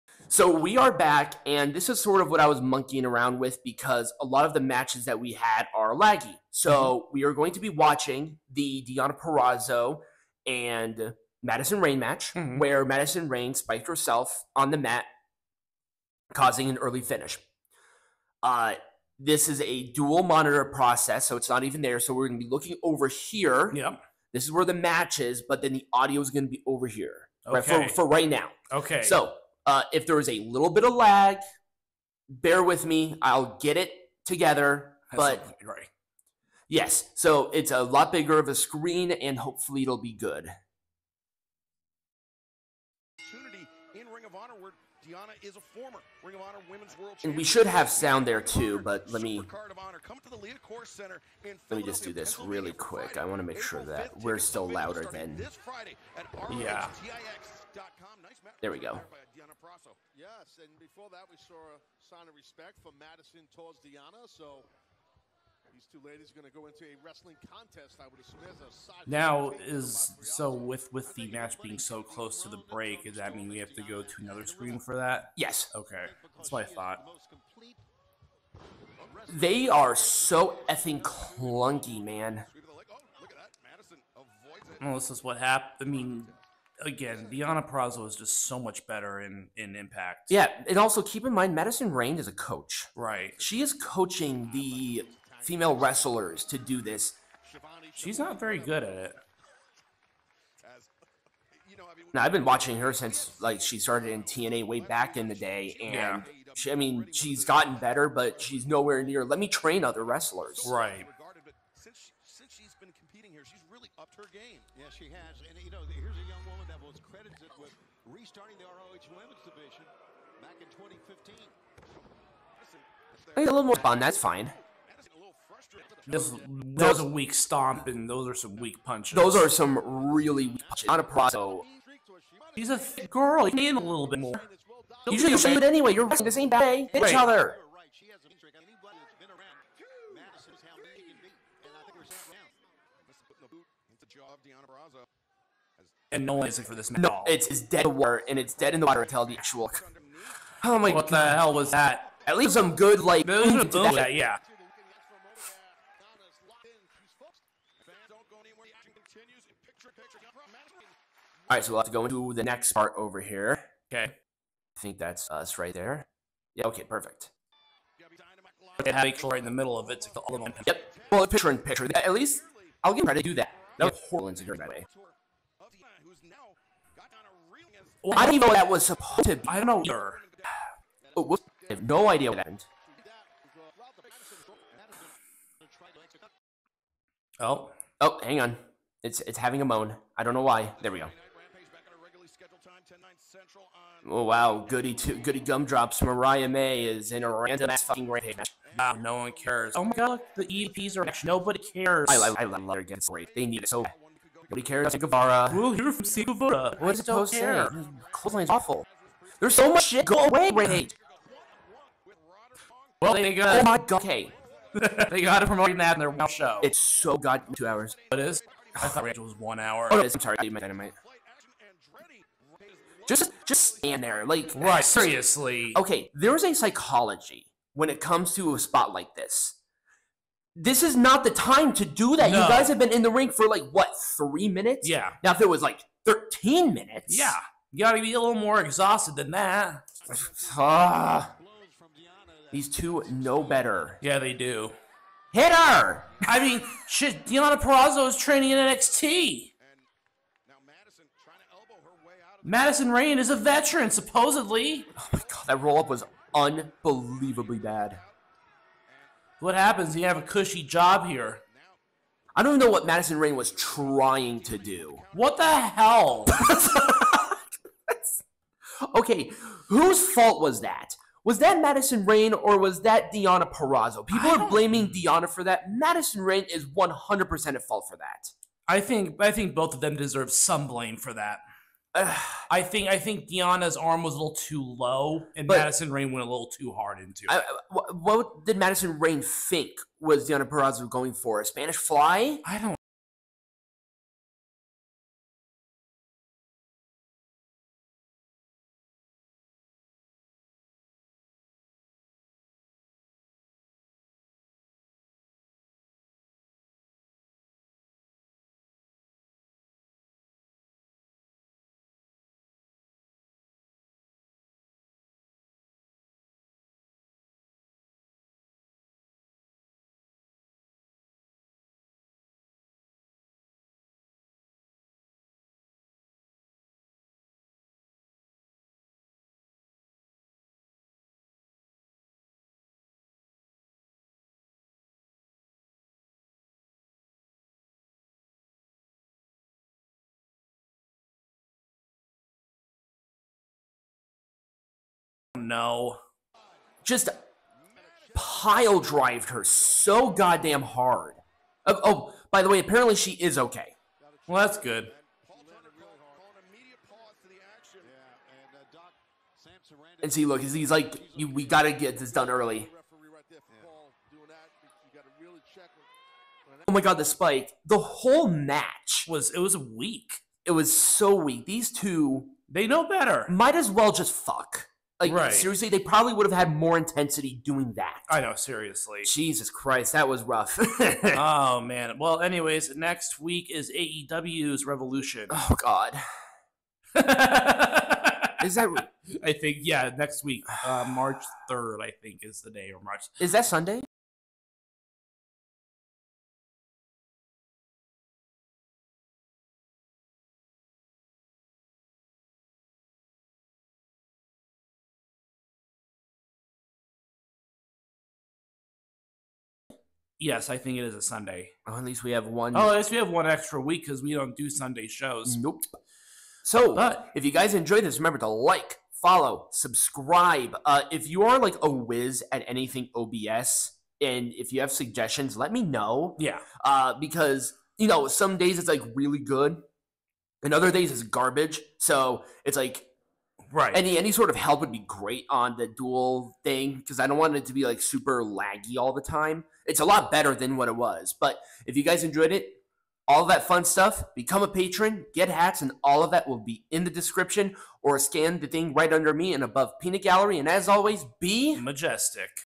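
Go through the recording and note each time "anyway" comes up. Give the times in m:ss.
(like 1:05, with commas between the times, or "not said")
2:15, 6:22.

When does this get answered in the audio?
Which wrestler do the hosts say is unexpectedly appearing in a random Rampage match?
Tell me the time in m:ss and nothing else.
3:16.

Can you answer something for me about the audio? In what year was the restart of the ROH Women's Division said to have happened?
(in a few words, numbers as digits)
2015.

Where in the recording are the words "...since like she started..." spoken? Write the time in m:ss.
1:42.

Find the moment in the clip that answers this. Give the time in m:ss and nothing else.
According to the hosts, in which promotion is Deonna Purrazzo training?
4:08.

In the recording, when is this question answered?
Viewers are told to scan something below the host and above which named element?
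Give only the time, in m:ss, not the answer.
7:29.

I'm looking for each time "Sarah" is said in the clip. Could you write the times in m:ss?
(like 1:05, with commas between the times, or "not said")
not said.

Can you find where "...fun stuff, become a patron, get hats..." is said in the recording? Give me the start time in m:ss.
7:23.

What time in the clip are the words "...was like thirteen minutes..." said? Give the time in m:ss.
3:55.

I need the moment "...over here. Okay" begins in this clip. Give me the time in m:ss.
2:42.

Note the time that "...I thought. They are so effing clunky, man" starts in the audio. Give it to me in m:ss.
1:16.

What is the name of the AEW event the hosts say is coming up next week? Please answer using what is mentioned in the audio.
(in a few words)
Revolution.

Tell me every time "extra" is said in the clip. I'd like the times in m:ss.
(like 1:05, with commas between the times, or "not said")
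6:53.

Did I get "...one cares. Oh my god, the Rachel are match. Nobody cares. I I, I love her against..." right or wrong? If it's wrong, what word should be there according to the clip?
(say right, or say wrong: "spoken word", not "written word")
wrong: "EPs", not "Rachel".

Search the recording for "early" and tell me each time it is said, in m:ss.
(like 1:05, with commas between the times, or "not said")
0:16, 6:02.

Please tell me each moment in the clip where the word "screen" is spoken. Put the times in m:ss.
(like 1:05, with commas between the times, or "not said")
0:38, 1:14.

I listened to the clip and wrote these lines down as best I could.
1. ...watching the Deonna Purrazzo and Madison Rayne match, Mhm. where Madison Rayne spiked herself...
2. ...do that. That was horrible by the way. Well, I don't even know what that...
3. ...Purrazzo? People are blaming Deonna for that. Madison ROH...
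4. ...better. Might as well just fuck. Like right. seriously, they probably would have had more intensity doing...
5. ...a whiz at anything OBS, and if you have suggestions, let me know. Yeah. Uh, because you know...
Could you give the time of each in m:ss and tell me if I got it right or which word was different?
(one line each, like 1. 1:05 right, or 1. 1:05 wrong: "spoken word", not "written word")
1. 0:07 right
2. 2:53 right
3. 4:33 wrong: "Rayne", not "ROH"
4. 6:12 right
5. 7:01 right.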